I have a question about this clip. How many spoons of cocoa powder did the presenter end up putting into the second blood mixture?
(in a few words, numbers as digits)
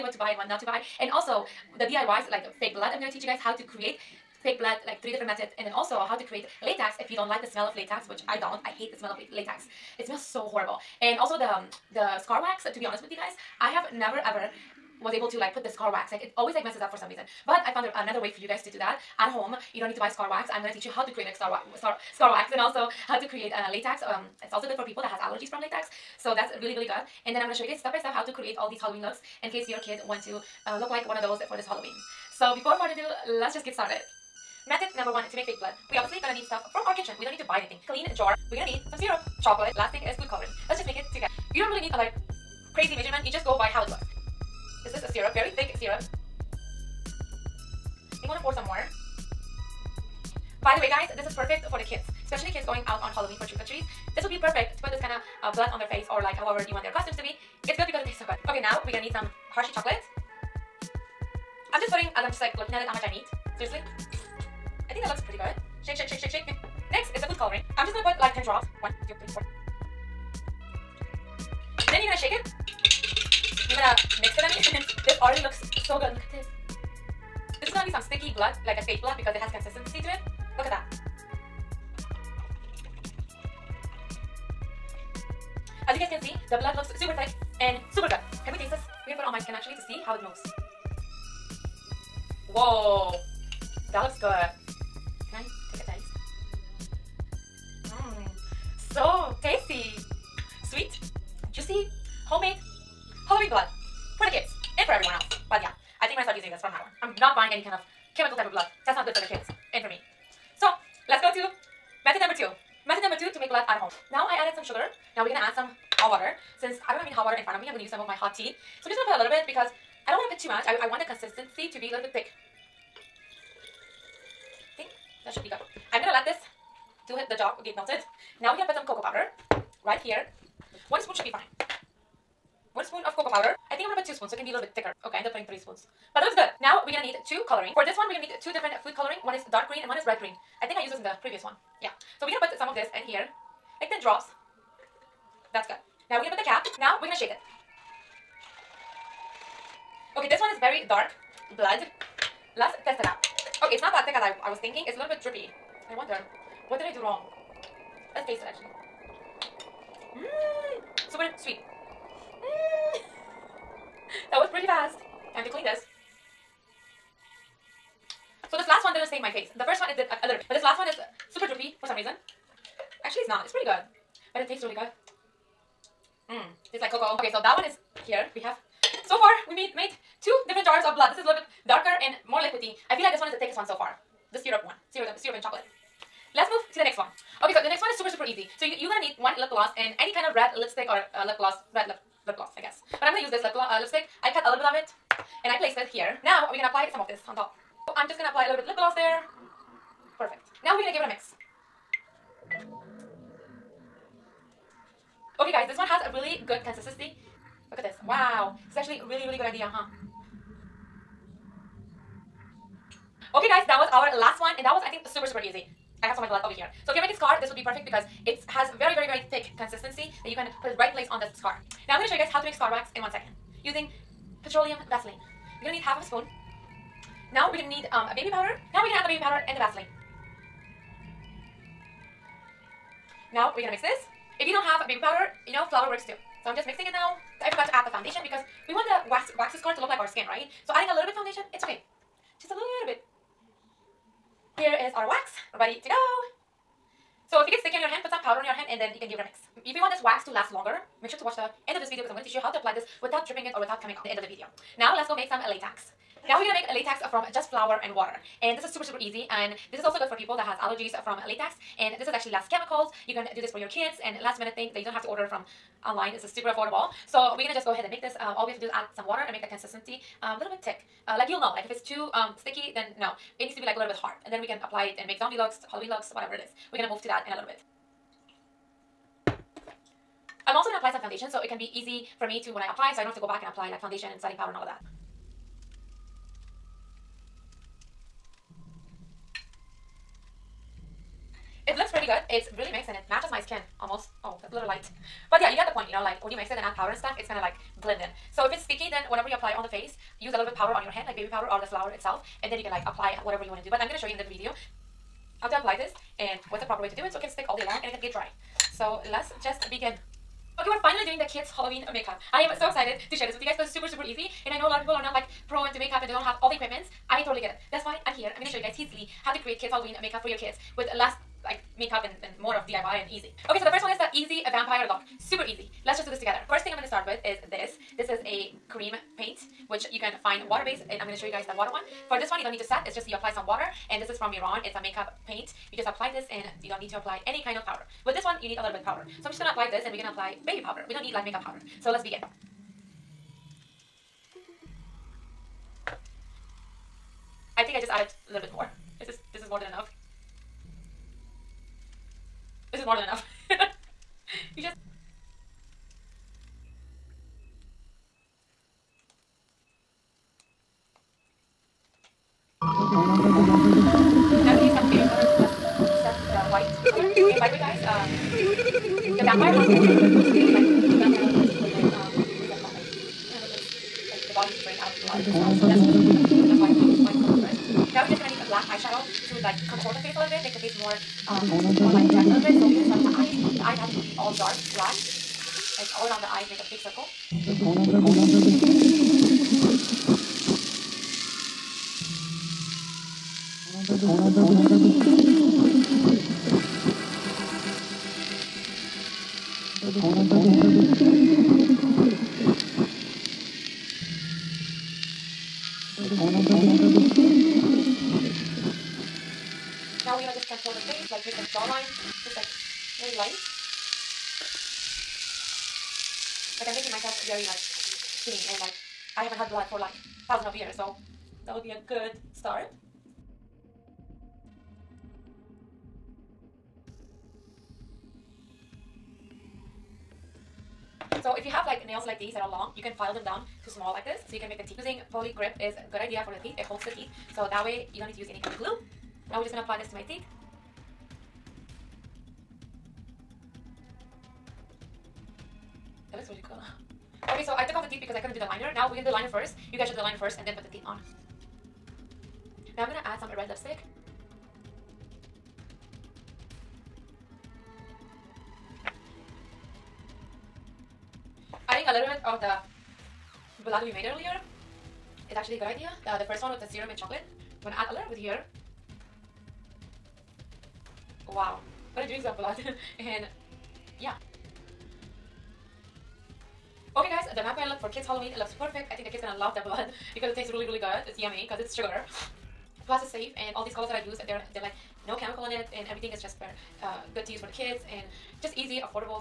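3.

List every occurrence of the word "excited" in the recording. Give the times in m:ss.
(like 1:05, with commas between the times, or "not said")
5:12.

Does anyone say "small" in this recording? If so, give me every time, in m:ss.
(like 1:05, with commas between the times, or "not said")
7:13.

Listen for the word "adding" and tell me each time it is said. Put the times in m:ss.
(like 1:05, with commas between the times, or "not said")
4:00, 7:41.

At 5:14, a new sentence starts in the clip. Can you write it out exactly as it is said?
And I know a lot of people are not like pro into makeup and they don't have all the equipments.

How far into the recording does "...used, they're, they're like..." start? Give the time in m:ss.
8:04.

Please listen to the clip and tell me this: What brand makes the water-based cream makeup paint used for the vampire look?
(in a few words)
Mehron.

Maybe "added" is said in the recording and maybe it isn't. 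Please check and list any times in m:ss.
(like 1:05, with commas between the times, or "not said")
1:54, 5:47.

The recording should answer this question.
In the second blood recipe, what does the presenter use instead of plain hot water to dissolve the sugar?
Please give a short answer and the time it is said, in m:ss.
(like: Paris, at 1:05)
hot tea, at 1:58.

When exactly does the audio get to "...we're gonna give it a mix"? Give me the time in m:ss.
3:20.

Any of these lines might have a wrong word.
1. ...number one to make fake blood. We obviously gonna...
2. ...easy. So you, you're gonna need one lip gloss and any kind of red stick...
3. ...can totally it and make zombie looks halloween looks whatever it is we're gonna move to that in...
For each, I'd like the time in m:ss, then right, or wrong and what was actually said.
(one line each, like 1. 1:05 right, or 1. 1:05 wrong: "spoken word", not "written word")
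1. 0:34 right
2. 3:08 wrong: "lipstick", not "stick"
3. 4:34 wrong: "apply", not "totally".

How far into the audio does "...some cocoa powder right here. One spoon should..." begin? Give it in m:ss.
2:08.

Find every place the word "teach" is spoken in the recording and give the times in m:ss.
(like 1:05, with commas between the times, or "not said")
0:03, 0:20, 4:12.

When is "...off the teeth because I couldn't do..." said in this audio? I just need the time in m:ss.
7:27.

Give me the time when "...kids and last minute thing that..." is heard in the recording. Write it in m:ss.
4:23.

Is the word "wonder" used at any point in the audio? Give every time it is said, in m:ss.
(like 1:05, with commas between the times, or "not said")
2:35.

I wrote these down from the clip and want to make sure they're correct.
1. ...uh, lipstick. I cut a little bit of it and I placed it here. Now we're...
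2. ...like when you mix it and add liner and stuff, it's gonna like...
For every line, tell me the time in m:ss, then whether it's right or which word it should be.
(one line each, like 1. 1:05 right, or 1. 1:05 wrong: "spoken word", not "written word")
1. 3:13 right
2. 4:56 wrong: "powder", not "liner".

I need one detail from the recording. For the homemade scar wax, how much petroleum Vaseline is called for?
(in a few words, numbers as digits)
half of a spoon.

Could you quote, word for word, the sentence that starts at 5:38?
With this one, you need a little bit powder.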